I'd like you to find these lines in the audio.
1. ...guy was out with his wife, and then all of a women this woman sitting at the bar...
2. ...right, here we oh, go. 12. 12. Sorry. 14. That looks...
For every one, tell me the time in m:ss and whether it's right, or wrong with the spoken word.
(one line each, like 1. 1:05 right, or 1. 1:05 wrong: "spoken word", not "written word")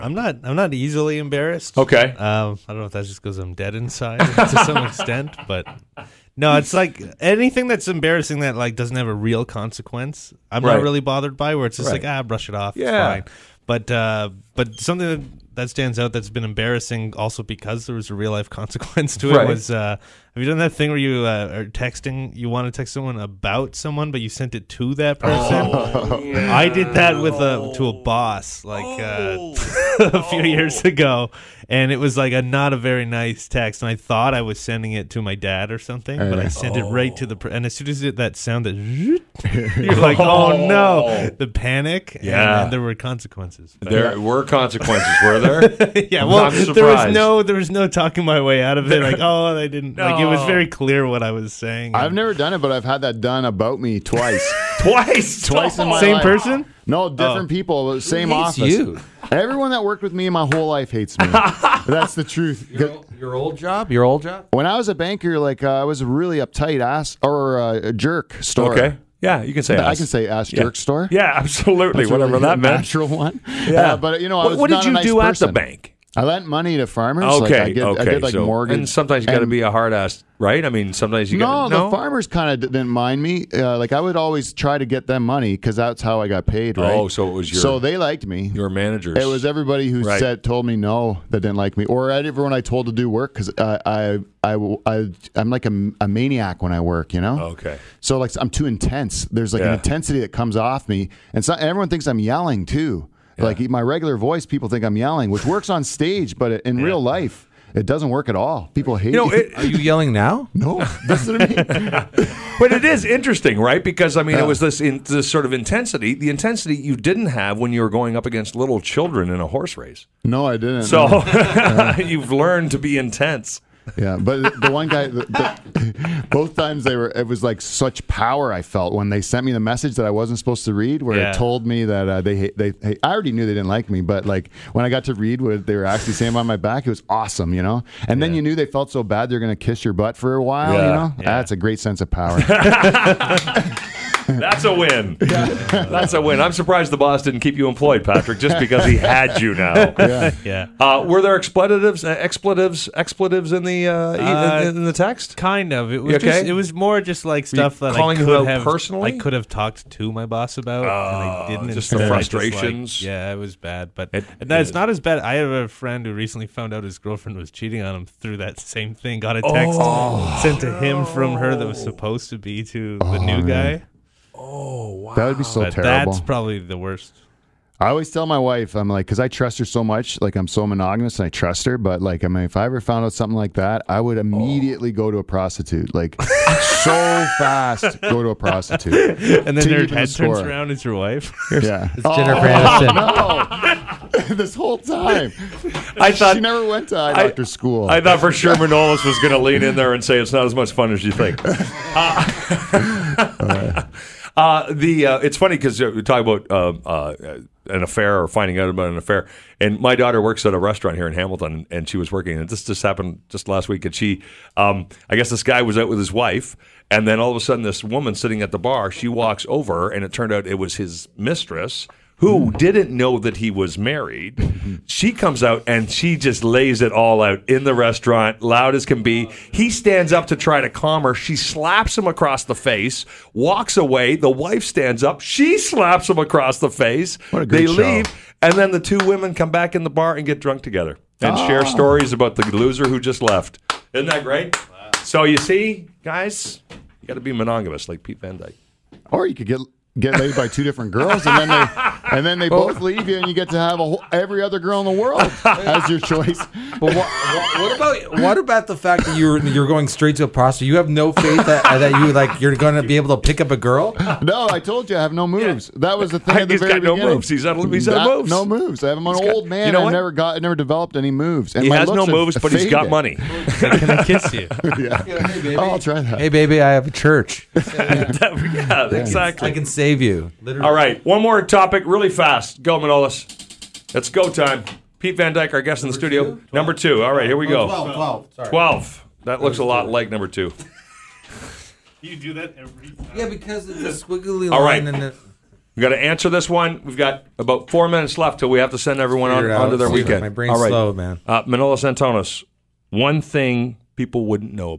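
1. 3:35 wrong: "sudden", not "women"
2. 4:47 wrong: "12", not "14".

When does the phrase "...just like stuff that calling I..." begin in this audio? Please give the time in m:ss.
2:37.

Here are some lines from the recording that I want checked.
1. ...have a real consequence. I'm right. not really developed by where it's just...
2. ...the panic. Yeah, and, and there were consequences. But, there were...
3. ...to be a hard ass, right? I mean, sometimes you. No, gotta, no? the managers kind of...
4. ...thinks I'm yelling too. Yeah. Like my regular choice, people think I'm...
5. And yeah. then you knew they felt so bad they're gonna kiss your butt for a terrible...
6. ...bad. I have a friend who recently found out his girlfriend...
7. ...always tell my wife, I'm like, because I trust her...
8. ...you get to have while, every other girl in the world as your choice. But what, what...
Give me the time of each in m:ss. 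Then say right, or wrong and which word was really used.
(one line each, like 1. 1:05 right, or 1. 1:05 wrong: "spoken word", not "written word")
1. 0:08 wrong: "bothered", not "developed"
2. 0:41 right
3. 1:19 wrong: "farmers", not "managers"
4. 1:41 wrong: "voice", not "choice"
5. 2:18 wrong: "while", not "terrible"
6. 2:44 right
7. 2:57 right
8. 4:13 wrong: "whole", not "while".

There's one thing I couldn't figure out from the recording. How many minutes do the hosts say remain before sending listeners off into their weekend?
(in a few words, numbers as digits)
4.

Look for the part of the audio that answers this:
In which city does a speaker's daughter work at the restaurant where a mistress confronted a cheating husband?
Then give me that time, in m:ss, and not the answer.
3:31.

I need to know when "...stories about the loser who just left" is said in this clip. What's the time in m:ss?
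4:01.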